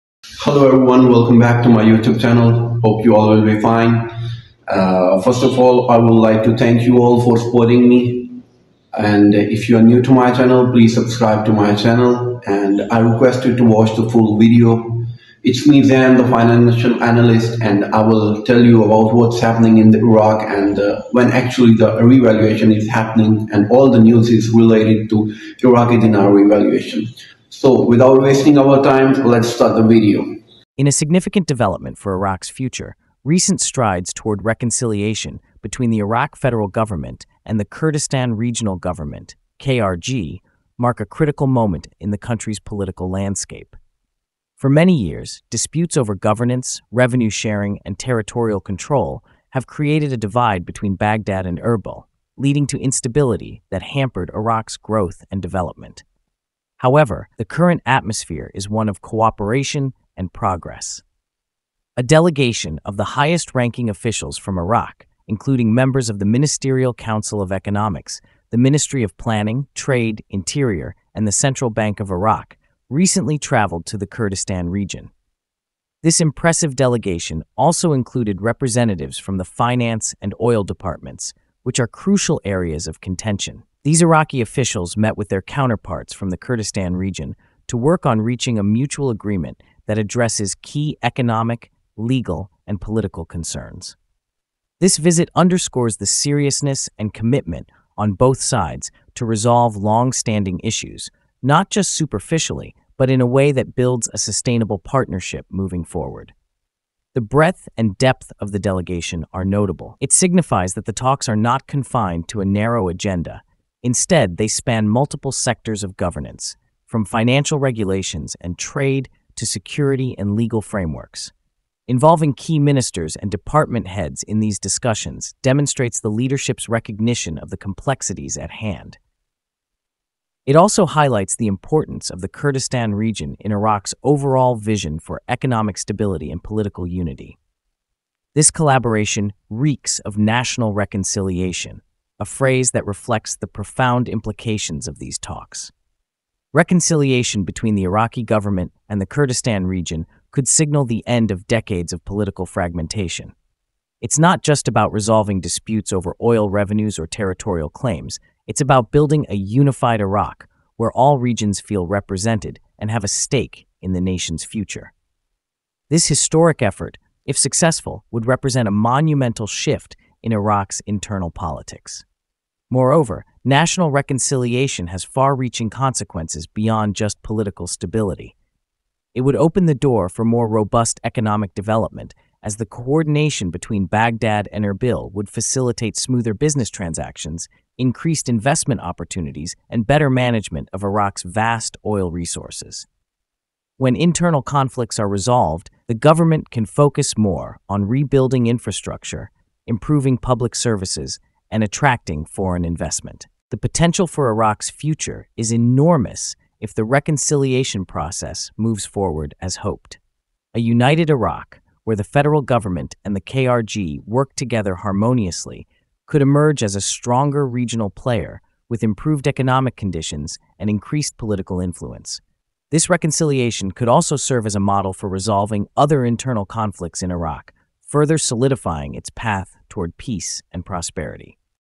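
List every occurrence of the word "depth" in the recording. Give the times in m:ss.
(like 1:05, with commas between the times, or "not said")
1:47.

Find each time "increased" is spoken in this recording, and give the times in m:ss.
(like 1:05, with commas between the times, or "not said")
3:07, 3:40.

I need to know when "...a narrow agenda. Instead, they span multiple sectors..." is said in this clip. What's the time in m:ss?
1:52.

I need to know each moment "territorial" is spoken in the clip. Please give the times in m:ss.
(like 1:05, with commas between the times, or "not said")
0:47, 2:37.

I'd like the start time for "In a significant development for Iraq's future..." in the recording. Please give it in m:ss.
0:30.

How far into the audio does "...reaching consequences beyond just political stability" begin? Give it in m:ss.
2:55.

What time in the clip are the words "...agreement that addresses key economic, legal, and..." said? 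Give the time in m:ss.
1:29.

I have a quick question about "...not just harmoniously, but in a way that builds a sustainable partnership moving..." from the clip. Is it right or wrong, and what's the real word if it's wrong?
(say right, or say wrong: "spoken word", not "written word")
wrong: "superficially", not "harmoniously".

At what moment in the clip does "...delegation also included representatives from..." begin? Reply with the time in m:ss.
1:16.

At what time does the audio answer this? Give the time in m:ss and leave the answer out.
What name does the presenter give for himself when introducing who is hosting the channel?
0:15.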